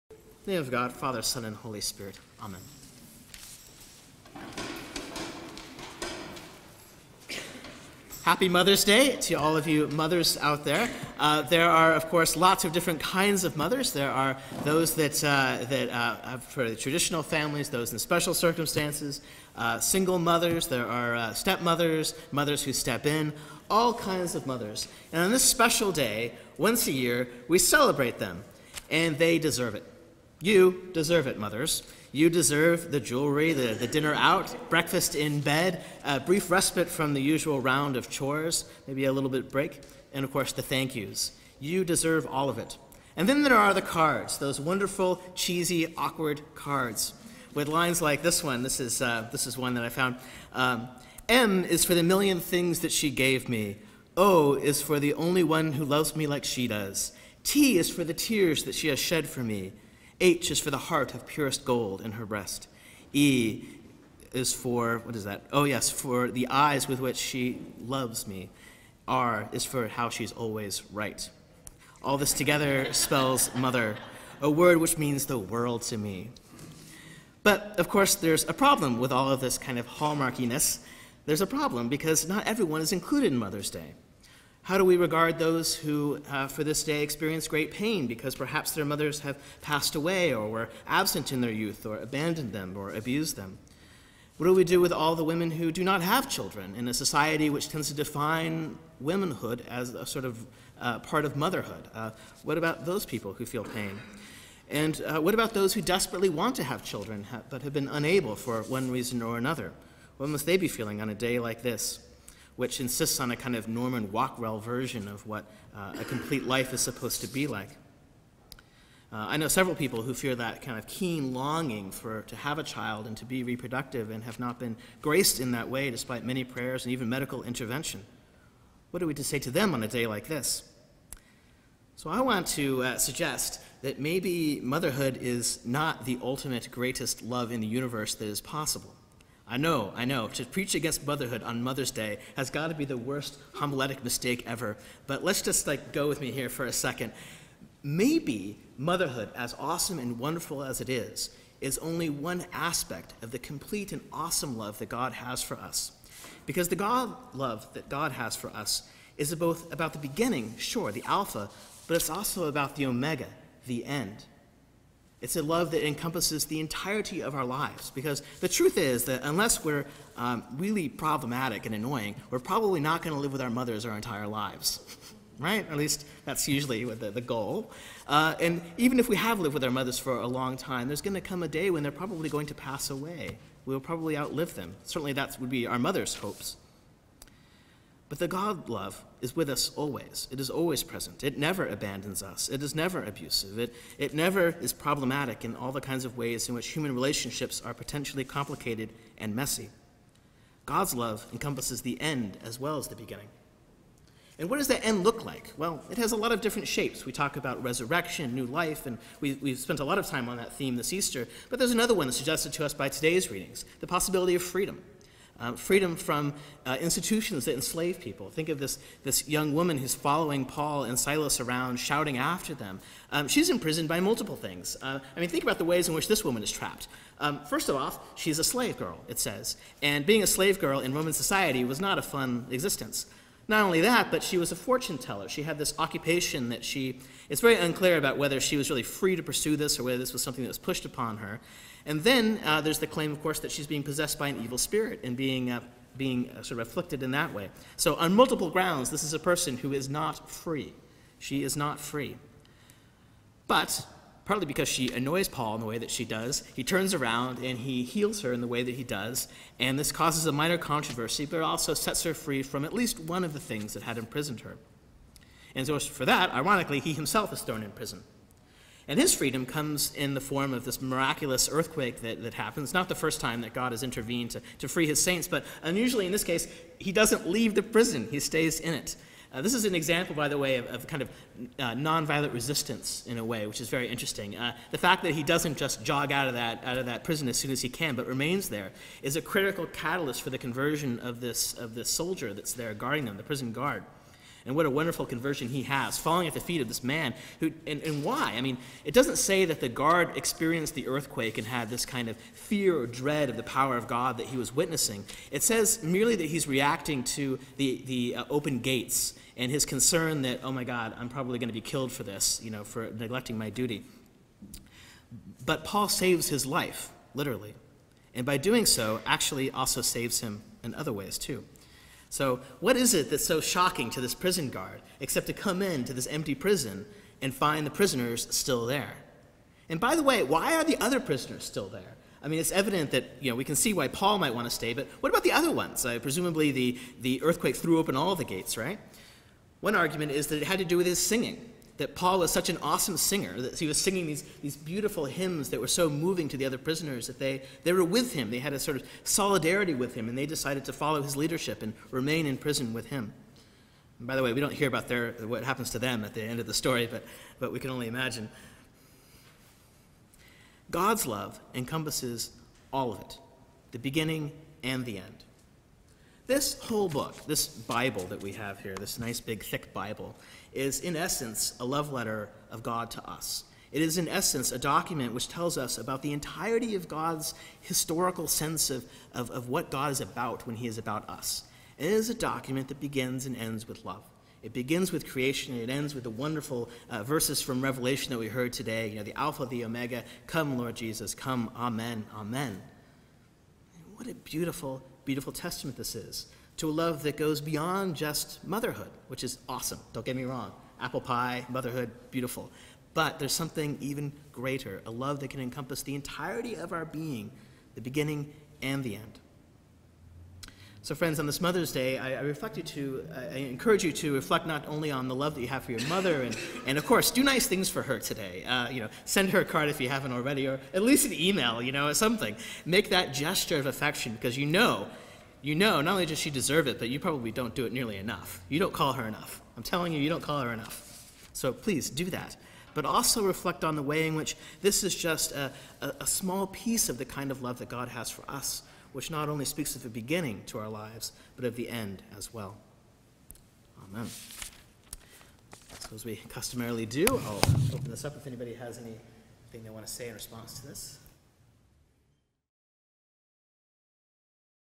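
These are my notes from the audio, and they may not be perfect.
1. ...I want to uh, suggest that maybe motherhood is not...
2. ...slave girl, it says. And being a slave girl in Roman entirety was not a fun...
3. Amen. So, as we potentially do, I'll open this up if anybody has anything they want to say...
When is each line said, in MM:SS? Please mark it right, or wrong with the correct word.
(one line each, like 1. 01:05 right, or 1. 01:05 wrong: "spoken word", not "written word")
1. 02:12 right
2. 03:48 wrong: "society", not "entirety"
3. 07:23 wrong: "customarily", not "potentially".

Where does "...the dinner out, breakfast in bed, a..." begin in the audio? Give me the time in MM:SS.
00:33.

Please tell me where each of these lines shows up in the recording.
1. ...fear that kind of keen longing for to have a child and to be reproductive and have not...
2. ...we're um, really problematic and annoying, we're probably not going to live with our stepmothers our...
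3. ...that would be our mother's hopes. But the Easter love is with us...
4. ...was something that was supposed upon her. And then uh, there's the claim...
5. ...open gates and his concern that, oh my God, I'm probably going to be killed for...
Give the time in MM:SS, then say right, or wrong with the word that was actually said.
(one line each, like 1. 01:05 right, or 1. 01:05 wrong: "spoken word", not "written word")
1. 02:00 right
2. 02:49 wrong: "mothers", not "stepmothers"
3. 03:05 wrong: "God", not "Easter"
4. 04:00 wrong: "pushed", not "supposed"
5. 05:08 right.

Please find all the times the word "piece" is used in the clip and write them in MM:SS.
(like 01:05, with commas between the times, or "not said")
07:16.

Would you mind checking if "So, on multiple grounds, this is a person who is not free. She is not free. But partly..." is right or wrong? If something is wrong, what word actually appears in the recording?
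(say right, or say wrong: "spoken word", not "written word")
right.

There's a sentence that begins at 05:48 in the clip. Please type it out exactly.
They had a sort of solidarity with him, and they decided to follow his leadership and remain in prison with him.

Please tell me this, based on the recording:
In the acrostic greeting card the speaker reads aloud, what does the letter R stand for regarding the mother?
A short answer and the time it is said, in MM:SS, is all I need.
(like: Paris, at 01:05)
always right, at 01:10.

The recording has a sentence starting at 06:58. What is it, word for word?
Uh, you know, send her a card if you haven't already, or at least an email, you know, or something.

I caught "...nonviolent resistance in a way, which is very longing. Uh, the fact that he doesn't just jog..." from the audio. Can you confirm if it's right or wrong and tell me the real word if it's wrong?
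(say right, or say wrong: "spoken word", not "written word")
wrong: "interesting", not "longing".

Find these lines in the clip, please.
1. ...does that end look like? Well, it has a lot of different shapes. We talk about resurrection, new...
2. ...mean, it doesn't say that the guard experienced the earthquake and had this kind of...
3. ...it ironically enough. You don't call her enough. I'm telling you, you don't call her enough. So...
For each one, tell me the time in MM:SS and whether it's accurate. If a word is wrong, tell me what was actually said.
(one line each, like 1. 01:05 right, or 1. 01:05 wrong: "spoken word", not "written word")
1. 03:24 right
2. 04:58 right
3. 07:07 wrong: "nearly", not "ironically".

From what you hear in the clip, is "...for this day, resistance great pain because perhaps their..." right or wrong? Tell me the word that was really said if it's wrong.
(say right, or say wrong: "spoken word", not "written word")
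wrong: "experience", not "resistance".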